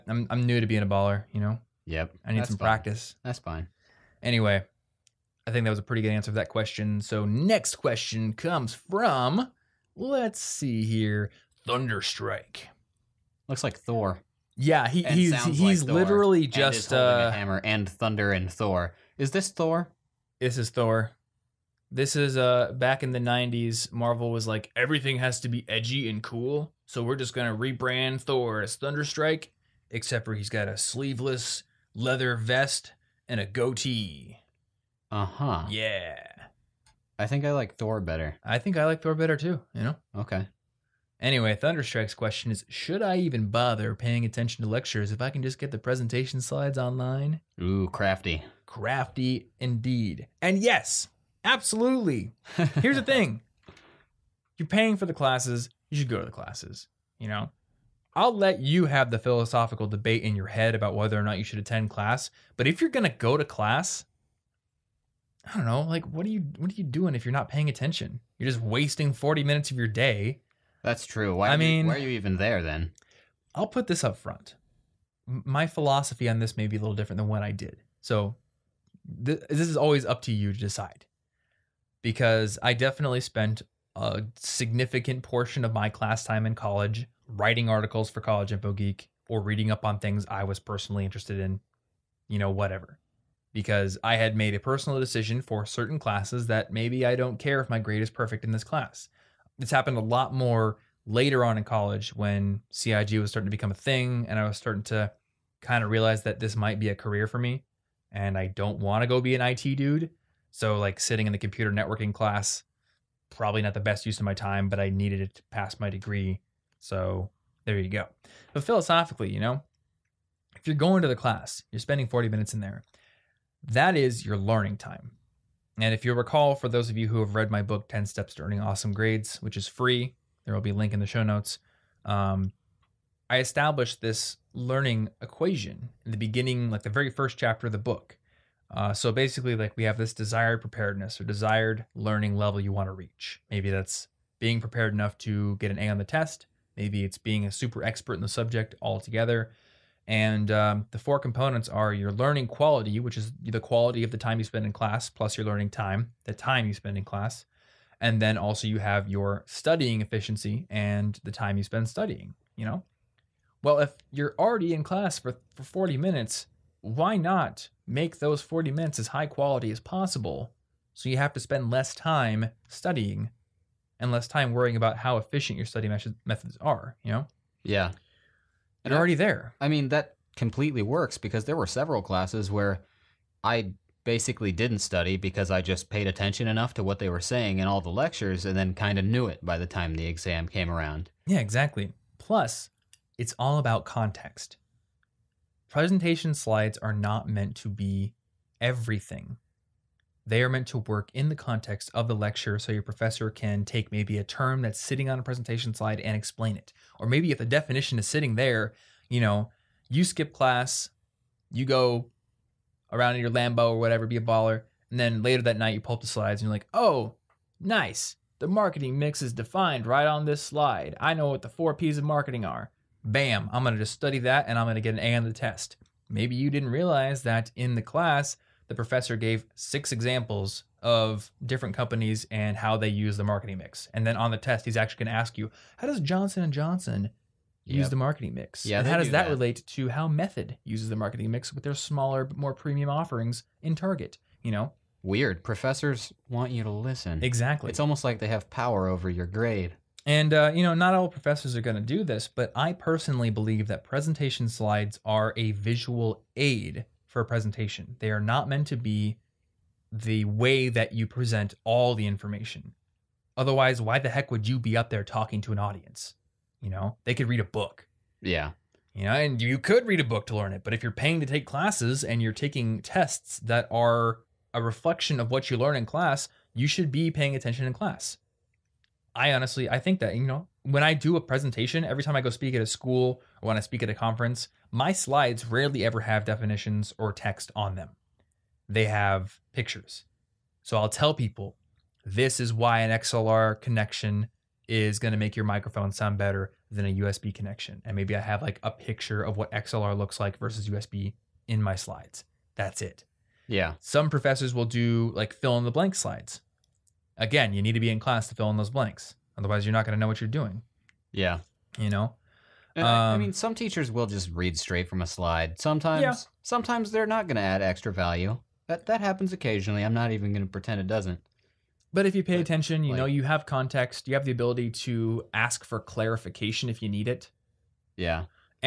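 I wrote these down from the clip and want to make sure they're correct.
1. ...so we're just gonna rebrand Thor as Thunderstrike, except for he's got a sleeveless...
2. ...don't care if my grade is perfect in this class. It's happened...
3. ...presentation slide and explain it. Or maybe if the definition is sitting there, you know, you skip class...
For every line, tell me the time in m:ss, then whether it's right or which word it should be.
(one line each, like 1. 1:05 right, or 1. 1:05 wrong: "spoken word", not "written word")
1. 0:26 right
2. 1:37 right
3. 3:25 right.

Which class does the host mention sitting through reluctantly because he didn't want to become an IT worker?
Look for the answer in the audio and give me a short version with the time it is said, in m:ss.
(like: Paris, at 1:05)
computer networking, at 1:51.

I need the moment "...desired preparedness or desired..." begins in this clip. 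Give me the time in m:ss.
2:20.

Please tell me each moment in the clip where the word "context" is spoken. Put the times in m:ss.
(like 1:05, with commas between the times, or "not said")
3:13, 3:21, 5:23.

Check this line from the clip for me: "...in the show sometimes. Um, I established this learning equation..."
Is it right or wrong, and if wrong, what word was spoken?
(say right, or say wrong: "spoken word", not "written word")
wrong: "notes", not "sometimes".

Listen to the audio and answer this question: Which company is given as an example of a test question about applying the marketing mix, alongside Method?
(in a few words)
Johnson and Johnson.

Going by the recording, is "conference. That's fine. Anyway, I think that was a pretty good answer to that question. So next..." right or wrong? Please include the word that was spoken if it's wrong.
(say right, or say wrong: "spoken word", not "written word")
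wrong: "practice", not "conference".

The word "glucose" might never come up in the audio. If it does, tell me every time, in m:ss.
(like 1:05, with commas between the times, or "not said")
not said.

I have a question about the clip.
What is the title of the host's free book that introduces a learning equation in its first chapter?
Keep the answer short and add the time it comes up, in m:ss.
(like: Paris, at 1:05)
10 Steps to Earning Awesome Grades, at 2:07.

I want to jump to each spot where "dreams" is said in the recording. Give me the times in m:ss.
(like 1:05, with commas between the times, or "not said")
not said.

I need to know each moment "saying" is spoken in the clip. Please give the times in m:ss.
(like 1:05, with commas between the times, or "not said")
3:07.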